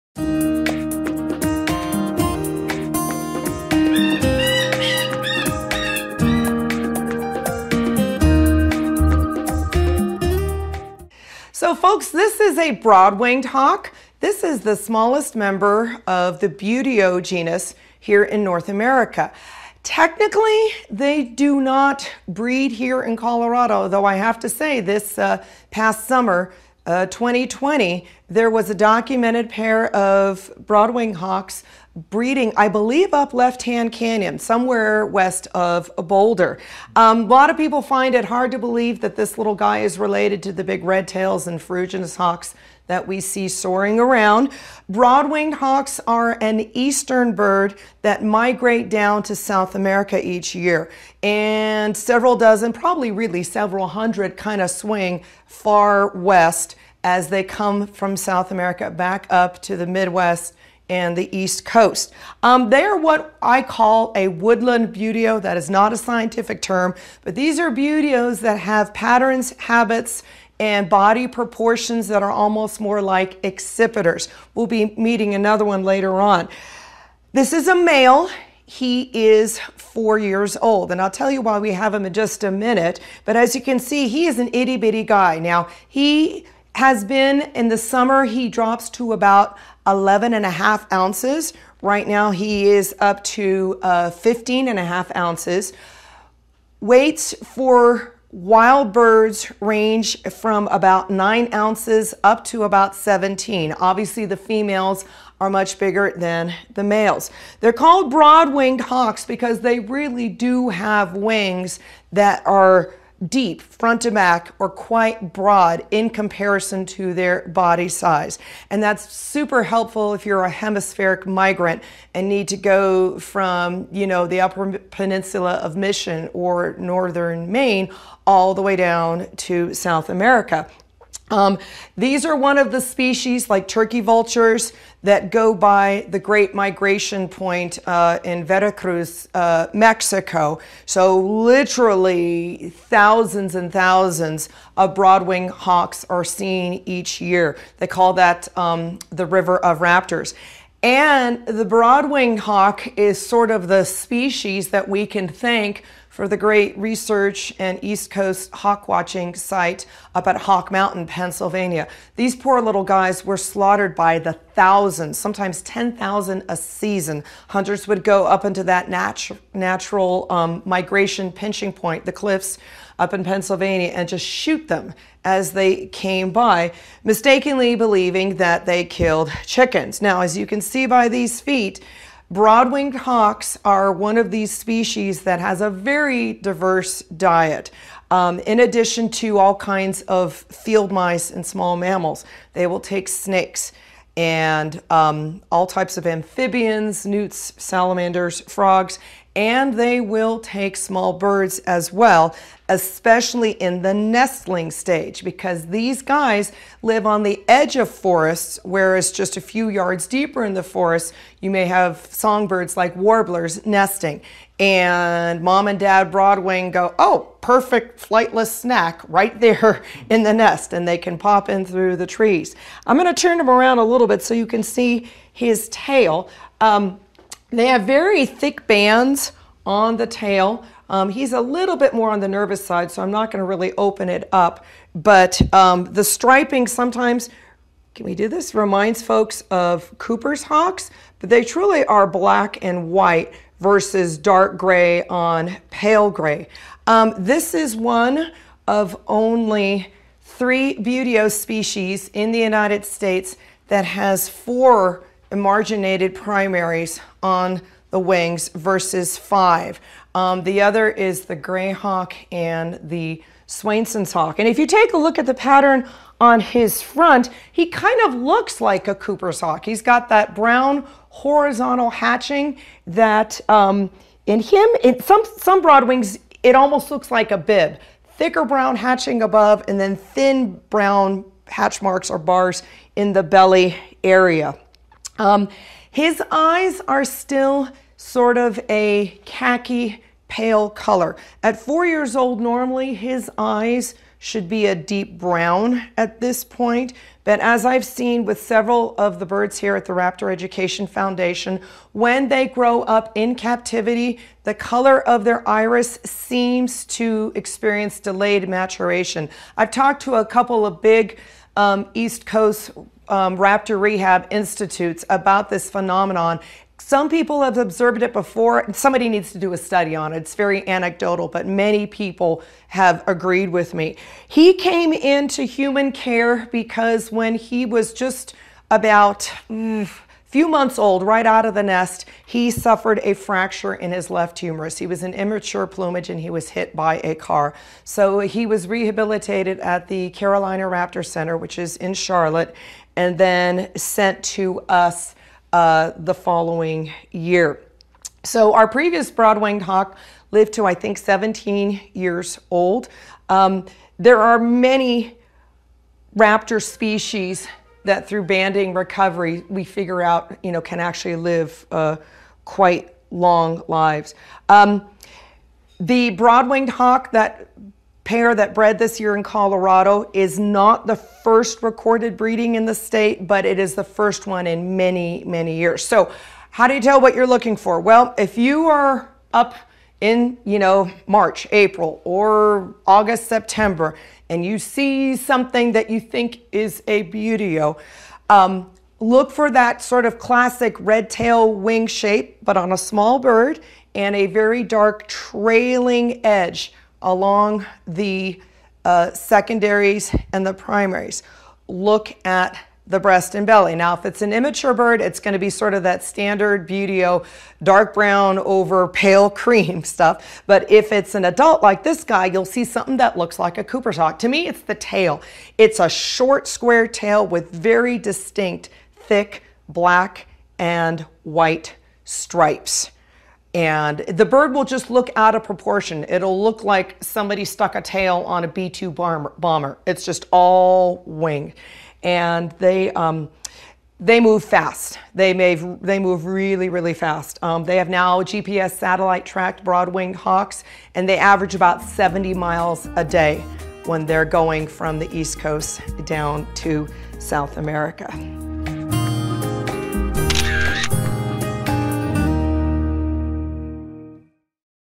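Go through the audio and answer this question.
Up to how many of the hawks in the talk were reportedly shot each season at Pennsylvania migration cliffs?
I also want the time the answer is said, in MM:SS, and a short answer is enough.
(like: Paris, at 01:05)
10,000, at 02:45.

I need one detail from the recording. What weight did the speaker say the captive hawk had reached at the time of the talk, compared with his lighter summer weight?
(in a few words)
15.5 ounces.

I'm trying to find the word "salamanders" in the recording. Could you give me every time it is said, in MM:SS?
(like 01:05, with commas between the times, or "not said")
03:17.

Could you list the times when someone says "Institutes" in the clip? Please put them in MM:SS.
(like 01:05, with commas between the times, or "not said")
05:14.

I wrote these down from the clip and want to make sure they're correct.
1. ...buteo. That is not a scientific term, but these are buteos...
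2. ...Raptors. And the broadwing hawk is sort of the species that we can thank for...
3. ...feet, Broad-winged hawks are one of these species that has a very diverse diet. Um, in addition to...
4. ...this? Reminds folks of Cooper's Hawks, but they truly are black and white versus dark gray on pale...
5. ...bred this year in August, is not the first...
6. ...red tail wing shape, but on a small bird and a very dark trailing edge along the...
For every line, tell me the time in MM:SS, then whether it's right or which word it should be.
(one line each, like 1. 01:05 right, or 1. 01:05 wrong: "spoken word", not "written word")
1. 01:04 right
2. 02:29 right
3. 03:01 right
4. 03:58 right
5. 06:08 wrong: "Colorado", not "August"
6. 06:30 right.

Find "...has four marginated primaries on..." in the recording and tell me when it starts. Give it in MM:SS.
04:13.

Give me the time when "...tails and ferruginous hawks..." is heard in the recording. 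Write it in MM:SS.
00:41.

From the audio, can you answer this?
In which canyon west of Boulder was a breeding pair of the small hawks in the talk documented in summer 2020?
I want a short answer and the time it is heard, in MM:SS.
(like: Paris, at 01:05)
Left Hand Canyon, at 00:33.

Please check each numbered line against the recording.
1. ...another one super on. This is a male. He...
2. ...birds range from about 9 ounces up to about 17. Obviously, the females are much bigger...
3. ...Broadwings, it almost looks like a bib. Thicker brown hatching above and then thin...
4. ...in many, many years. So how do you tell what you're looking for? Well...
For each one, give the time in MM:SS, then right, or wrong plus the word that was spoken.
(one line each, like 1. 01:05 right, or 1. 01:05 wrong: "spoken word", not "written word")
1. 01:15 wrong: "later", not "super"
2. 01:38 right
3. 04:35 right
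4. 06:14 right.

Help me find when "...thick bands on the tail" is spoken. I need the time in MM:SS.
03:48.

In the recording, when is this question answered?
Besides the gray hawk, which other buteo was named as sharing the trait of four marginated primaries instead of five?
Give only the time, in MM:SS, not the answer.
04:23.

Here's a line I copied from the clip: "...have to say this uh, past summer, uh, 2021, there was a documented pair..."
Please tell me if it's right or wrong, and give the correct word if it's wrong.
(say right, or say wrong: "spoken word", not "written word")
wrong: "2020", not "2021".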